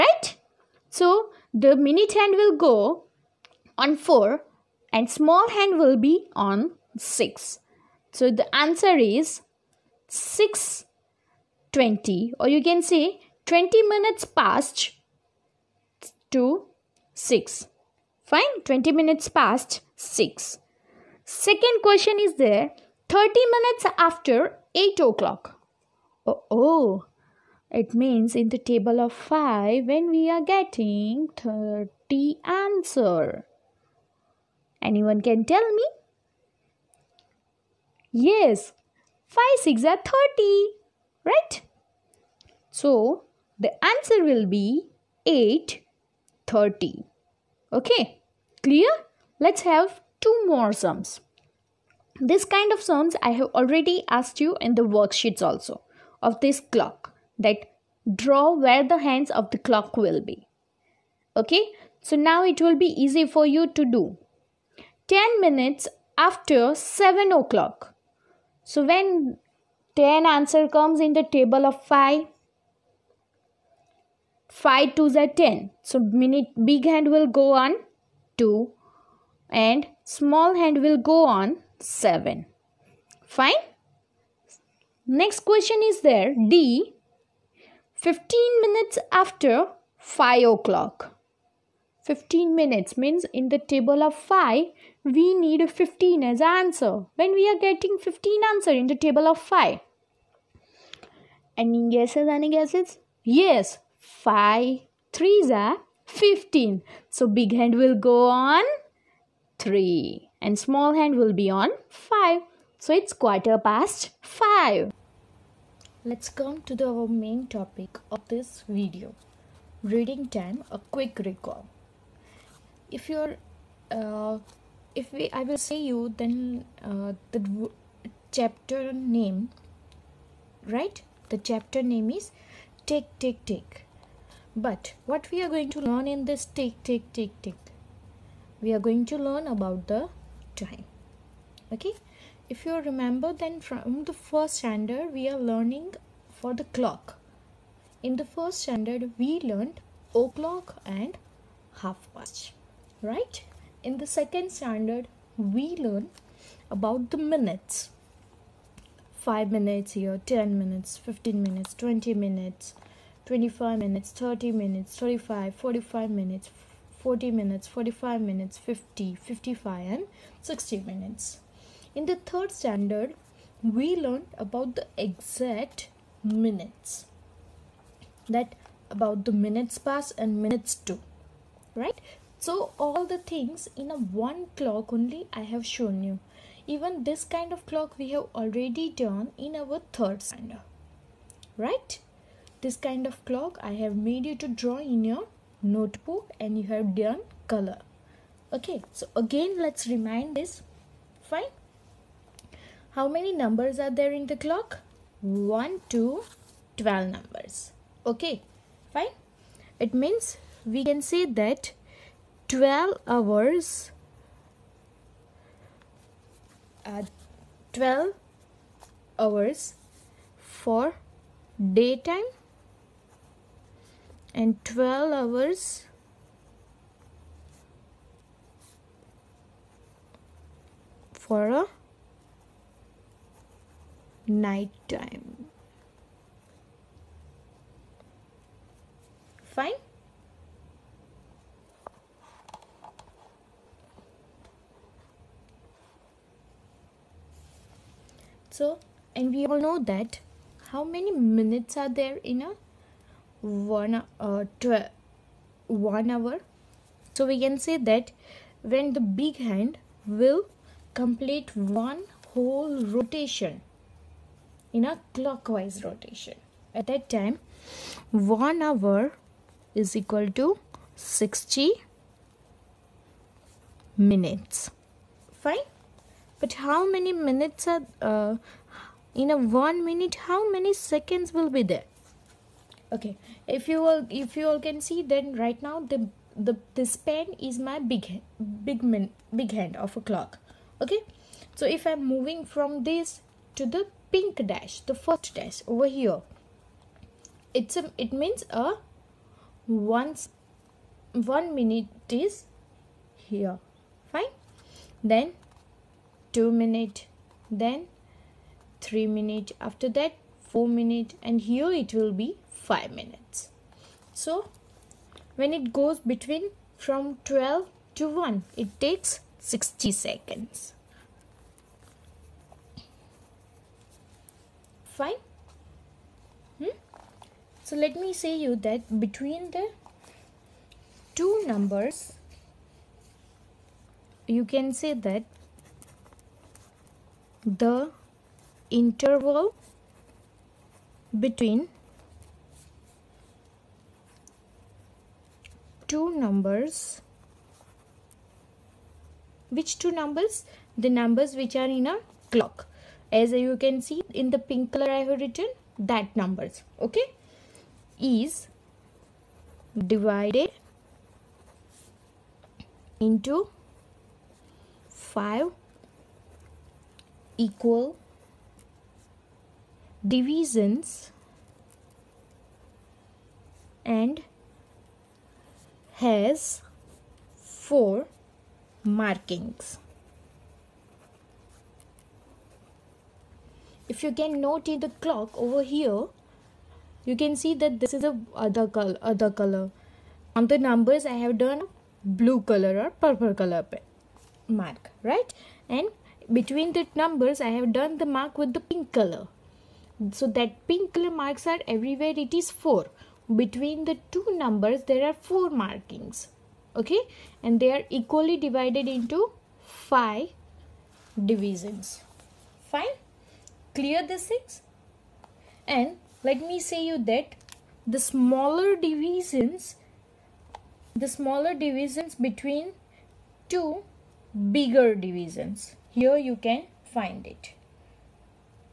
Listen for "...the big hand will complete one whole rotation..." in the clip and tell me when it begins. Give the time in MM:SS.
04:18.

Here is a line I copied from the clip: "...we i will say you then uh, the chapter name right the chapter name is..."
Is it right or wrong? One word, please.
right.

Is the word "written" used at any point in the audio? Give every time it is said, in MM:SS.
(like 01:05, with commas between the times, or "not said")
05:55.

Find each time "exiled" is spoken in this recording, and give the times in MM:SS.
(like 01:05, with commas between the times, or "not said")
not said.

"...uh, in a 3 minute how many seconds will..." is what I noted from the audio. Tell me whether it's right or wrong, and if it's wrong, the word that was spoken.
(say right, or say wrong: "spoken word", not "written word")
wrong: "1", not "3".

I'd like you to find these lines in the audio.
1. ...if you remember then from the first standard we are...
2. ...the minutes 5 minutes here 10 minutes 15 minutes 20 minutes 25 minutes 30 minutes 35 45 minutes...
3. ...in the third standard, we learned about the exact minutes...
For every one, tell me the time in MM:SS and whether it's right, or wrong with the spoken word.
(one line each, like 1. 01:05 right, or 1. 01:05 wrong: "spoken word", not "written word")
1. 02:22 right
2. 02:37 right
3. 02:51 right.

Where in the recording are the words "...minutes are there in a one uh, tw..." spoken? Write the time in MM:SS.
04:11.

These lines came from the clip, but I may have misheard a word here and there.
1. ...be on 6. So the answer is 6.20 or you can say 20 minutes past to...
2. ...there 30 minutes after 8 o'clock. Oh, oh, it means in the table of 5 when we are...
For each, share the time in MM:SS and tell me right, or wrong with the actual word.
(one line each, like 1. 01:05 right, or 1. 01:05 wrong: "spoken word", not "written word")
1. 00:05 right
2. 00:22 right.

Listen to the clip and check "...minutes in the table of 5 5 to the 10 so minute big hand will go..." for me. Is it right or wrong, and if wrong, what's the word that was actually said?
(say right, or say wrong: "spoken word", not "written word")
wrong: "comes", not "minutes".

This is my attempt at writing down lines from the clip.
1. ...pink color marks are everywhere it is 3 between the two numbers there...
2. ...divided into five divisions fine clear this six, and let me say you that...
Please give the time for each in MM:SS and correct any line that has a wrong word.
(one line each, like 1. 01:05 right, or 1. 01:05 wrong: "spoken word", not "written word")
1. 06:40 wrong: "4", not "3"
2. 06:48 right.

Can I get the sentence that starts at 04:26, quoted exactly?
At that time, 1 hour is equal to 60 minutes.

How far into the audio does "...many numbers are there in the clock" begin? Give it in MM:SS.
03:23.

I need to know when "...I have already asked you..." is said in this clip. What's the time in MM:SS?
00:53.